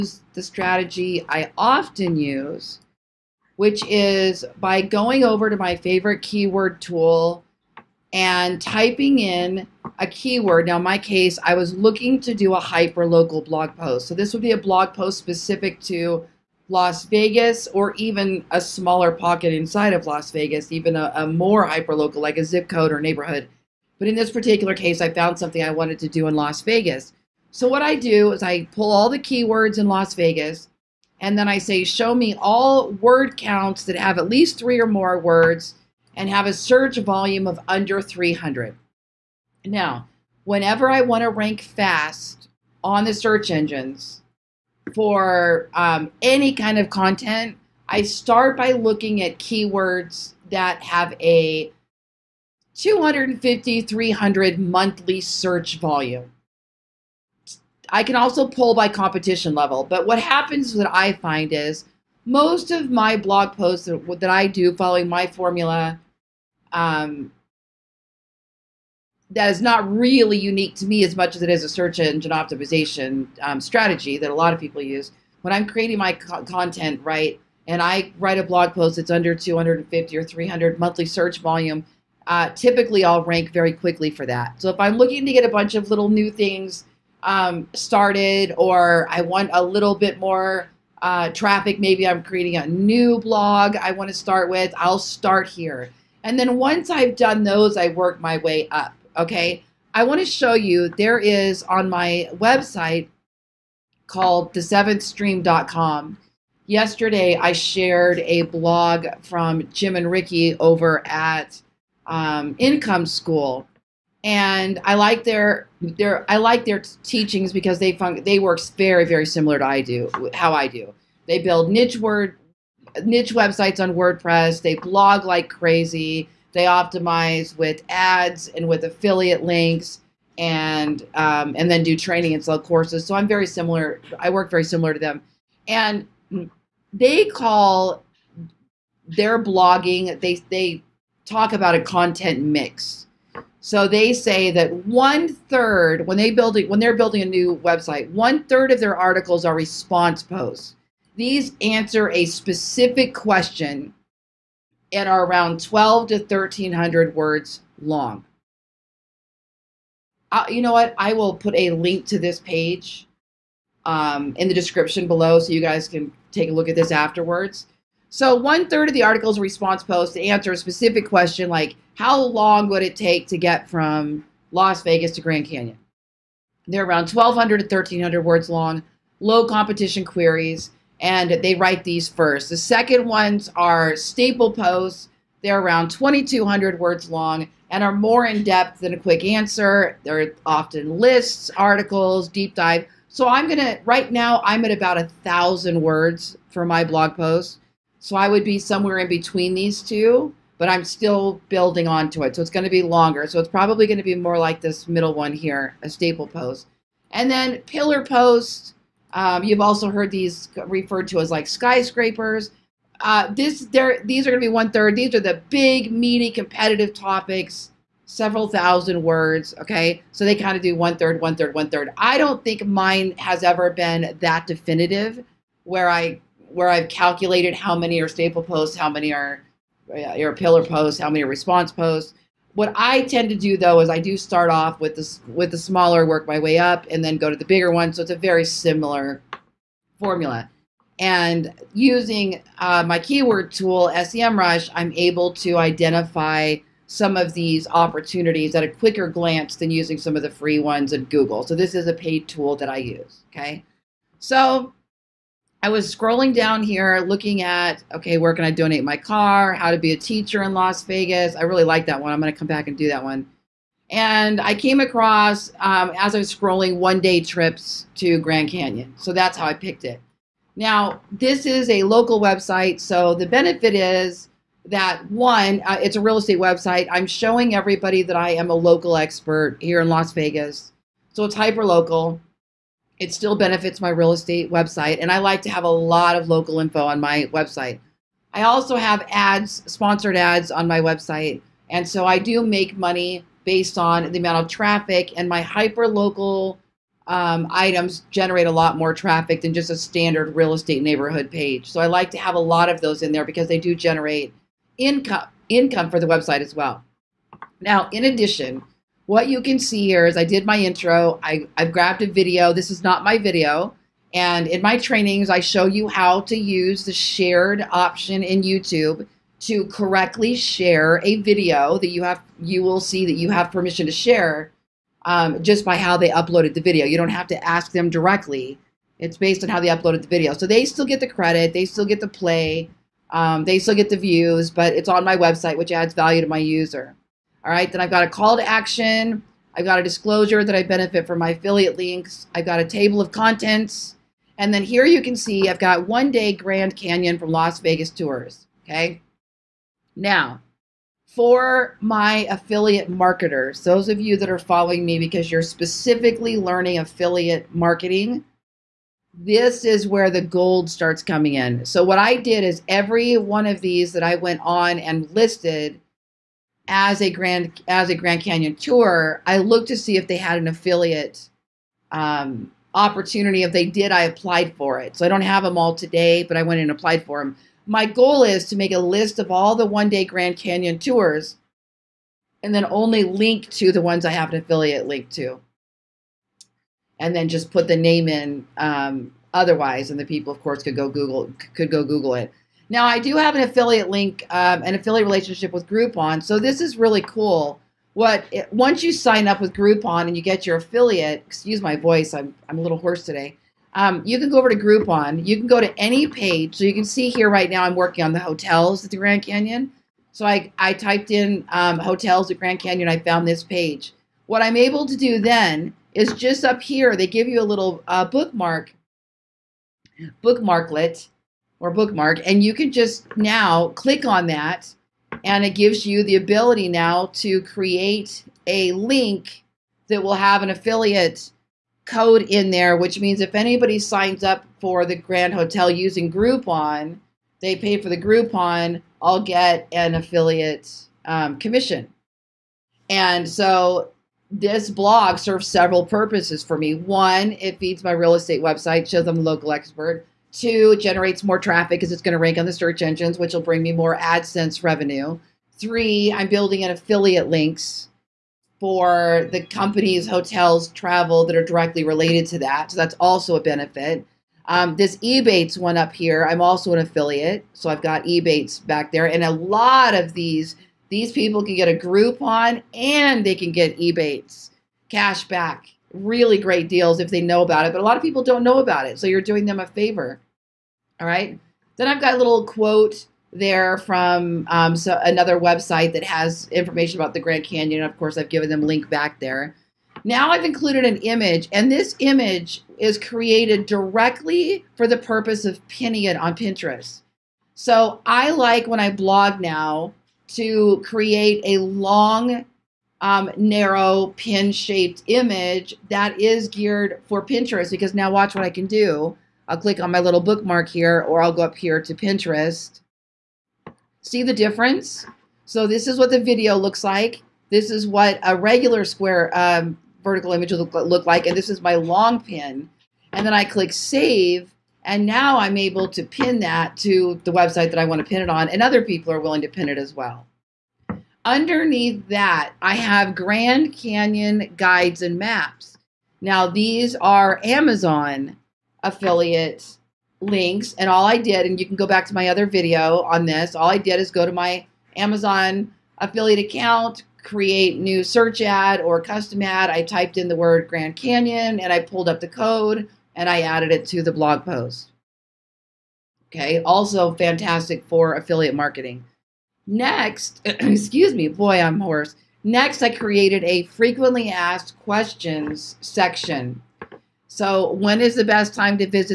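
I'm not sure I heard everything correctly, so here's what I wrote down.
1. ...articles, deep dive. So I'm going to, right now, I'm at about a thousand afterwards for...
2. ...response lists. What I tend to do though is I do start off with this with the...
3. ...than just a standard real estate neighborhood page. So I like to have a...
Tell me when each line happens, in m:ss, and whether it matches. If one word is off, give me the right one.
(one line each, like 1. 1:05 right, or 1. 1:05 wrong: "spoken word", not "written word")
1. 3:11 wrong: "words", not "afterwards"
2. 3:51 wrong: "posts", not "lists"
3. 4:59 right.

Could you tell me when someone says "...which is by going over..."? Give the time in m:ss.
0:03.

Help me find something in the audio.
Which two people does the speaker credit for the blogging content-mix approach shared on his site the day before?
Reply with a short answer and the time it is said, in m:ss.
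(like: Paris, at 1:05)
Jim and Ricky, at 1:49.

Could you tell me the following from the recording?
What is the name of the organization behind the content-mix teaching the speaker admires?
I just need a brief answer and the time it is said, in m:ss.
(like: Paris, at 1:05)
Income School, at 1:52.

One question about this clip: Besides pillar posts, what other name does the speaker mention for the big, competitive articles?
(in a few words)
skyscrapers.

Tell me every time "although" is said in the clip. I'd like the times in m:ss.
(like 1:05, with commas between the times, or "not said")
not said.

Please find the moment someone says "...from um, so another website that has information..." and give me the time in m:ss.
8:03.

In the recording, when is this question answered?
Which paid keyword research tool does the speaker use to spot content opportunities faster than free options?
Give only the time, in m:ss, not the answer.
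4:03.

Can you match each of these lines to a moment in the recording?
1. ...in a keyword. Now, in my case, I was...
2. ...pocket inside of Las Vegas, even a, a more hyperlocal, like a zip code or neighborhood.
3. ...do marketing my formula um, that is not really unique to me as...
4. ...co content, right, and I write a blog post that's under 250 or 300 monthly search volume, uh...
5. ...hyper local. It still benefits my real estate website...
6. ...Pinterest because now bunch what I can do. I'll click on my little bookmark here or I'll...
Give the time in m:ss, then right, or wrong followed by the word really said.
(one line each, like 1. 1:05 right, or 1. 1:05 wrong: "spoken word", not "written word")
1. 0:09 right
2. 0:19 right
3. 1:04 wrong: "following", not "marketing"
4. 1:16 right
5. 4:41 right
6. 8:27 wrong: "watch", not "bunch".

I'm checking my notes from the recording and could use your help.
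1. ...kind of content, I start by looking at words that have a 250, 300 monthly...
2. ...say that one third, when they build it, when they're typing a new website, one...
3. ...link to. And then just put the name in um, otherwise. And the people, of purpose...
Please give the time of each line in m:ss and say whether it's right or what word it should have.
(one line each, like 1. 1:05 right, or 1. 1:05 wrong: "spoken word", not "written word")
1. 0:46 wrong: "keywords", not "words"
2. 2:24 wrong: "building", not "typing"
3. 6:24 wrong: "course", not "purpose".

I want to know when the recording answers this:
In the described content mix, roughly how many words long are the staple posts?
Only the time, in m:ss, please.
3:05.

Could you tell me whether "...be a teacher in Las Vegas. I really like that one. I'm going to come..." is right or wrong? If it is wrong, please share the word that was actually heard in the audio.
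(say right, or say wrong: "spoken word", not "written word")
right.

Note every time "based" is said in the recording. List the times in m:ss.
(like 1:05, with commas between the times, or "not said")
4:53, 5:29.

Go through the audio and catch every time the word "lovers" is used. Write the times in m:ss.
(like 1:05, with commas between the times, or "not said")
not said.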